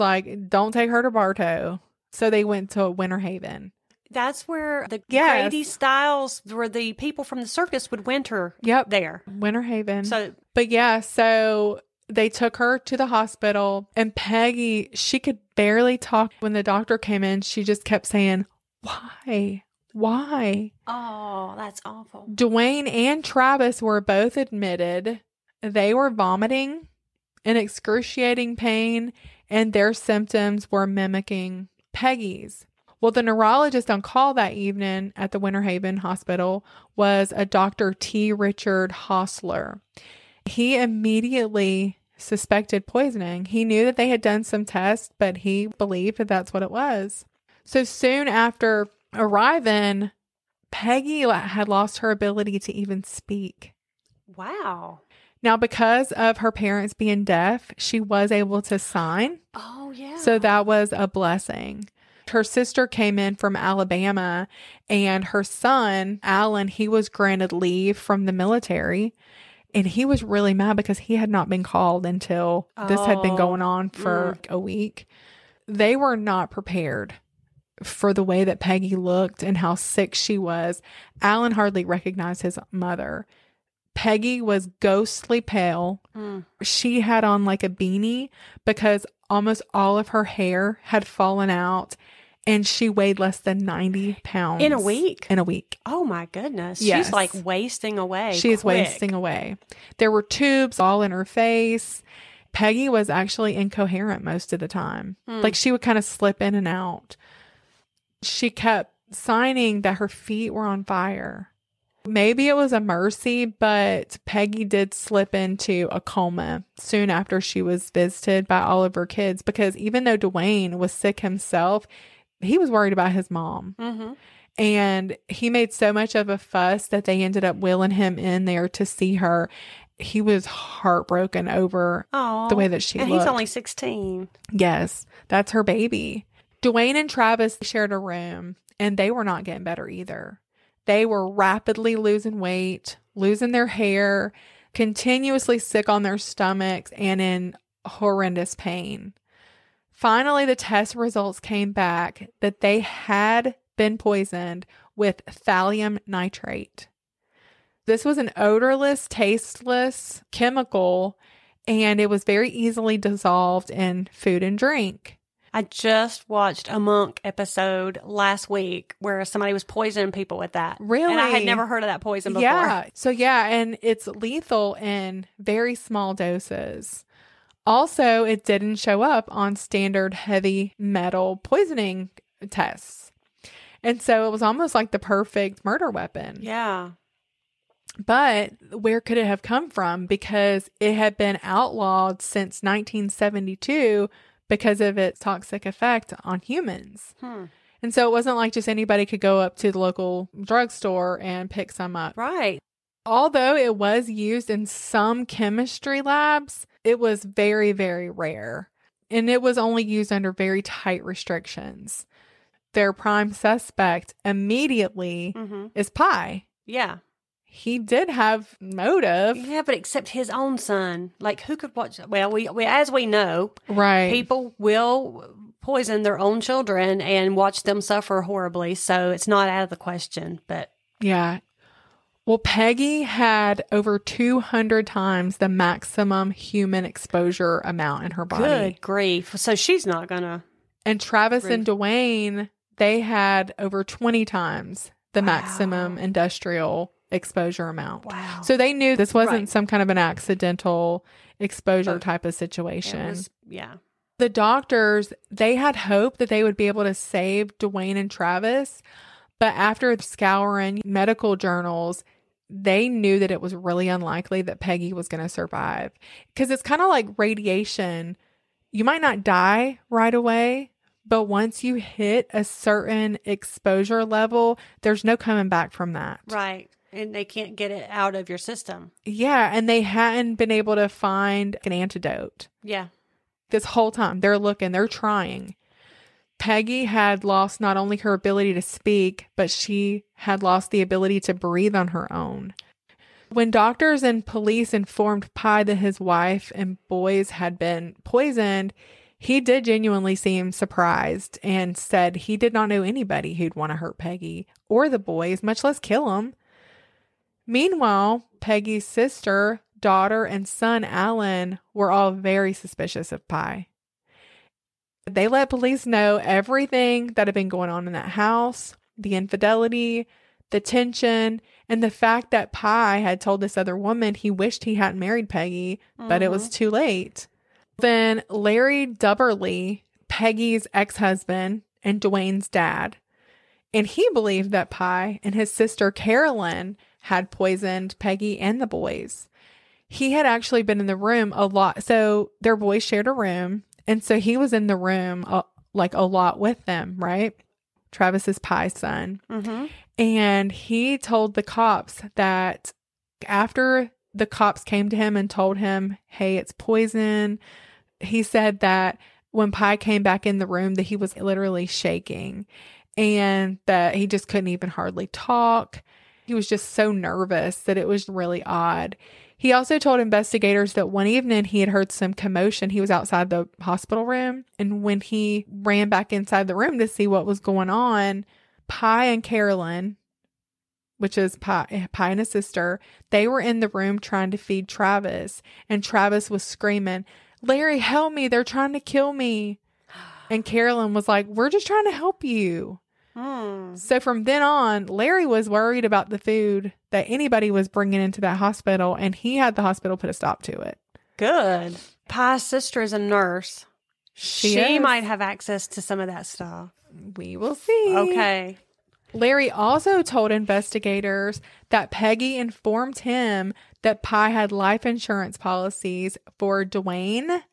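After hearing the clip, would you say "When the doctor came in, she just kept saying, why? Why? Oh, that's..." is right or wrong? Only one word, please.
right.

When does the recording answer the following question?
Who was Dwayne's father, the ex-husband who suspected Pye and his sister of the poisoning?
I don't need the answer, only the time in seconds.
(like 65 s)
328 s.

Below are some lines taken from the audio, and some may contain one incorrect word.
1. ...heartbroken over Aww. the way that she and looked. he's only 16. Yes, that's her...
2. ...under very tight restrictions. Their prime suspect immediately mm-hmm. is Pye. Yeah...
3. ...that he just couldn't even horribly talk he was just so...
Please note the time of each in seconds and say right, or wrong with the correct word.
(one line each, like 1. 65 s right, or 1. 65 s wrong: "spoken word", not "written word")
1. 130 s right
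2. 210 s right
3. 363 s wrong: "hardly", not "horribly".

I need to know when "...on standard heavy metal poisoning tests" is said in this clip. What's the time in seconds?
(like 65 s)
179 s.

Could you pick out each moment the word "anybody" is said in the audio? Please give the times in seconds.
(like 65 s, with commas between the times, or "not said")
198 s, 302 s, 397 s.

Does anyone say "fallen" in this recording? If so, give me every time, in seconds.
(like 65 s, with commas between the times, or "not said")
91 s.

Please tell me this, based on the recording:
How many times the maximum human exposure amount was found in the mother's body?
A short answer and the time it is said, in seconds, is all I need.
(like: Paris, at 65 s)
200, at 233 s.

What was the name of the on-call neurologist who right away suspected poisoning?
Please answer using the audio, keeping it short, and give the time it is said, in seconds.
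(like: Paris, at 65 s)
T. Richard Hostler, at 37 s.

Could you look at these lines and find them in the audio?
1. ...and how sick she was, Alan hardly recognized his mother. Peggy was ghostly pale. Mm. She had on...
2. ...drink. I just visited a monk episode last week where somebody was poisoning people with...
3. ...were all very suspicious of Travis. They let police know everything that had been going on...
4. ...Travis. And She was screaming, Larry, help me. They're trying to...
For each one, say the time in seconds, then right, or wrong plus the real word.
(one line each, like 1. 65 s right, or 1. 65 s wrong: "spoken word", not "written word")
1. 79 s right
2. 164 s wrong: "watched", not "visited"
3. 311 s wrong: "Pye", not "Travis"
4. 384 s wrong: "Travis", not "She".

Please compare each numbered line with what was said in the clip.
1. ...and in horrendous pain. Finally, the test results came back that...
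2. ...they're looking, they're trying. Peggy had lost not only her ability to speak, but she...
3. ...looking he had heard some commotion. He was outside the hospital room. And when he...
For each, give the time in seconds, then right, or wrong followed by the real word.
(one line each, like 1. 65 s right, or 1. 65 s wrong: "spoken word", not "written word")
1. 146 s right
2. 284 s right
3. 371 s wrong: "evening", not "looking".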